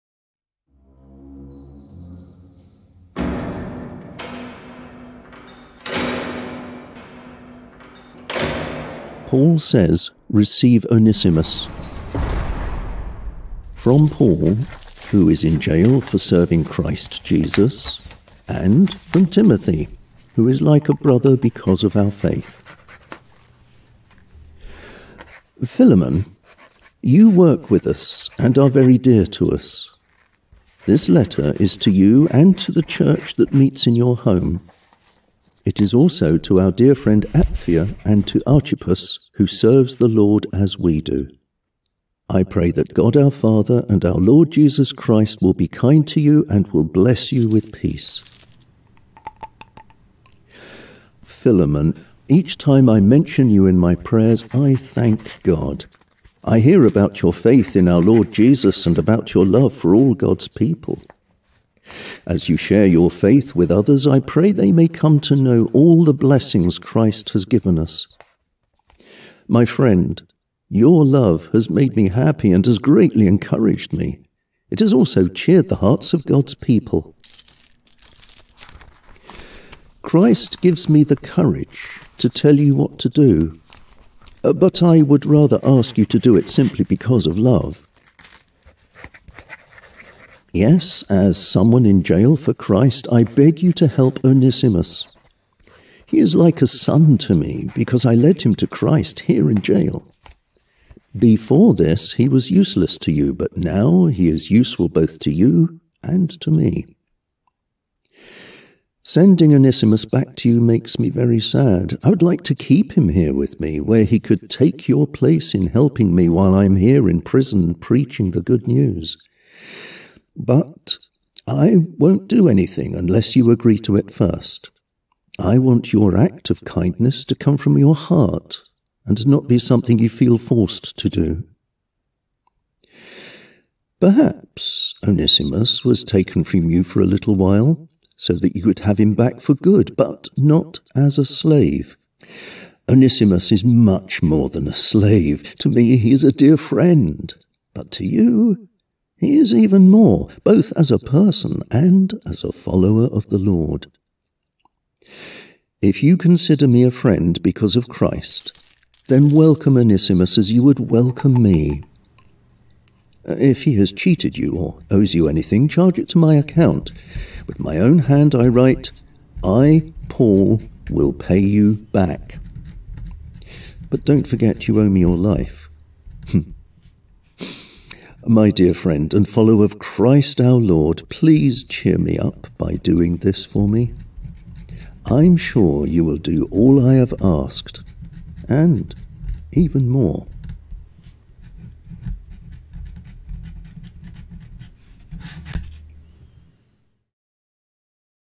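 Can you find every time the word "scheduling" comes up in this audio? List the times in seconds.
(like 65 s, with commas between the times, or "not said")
not said.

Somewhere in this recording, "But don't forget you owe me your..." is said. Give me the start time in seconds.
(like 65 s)
173 s.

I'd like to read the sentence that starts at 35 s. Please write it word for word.
It is also to our dear friend Apphia and to Archippus, who serves the Lord as we do.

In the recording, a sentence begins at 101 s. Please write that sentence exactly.
Before this, he was useless to you, but now he is useful both to you and to me.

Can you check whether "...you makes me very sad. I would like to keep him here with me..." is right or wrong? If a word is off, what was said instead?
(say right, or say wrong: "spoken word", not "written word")
right.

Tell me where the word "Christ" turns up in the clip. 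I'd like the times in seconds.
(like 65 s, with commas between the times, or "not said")
16 s, 44 s, 66 s, 80 s, 92 s, 98 s, 157 s, 179 s.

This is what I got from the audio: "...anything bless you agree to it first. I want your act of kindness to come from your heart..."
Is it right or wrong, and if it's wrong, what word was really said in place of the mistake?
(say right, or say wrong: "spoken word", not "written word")
wrong: "unless", not "bless".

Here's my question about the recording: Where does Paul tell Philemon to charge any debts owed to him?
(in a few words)
my account.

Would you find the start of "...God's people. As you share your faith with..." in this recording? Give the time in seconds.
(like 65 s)
60 s.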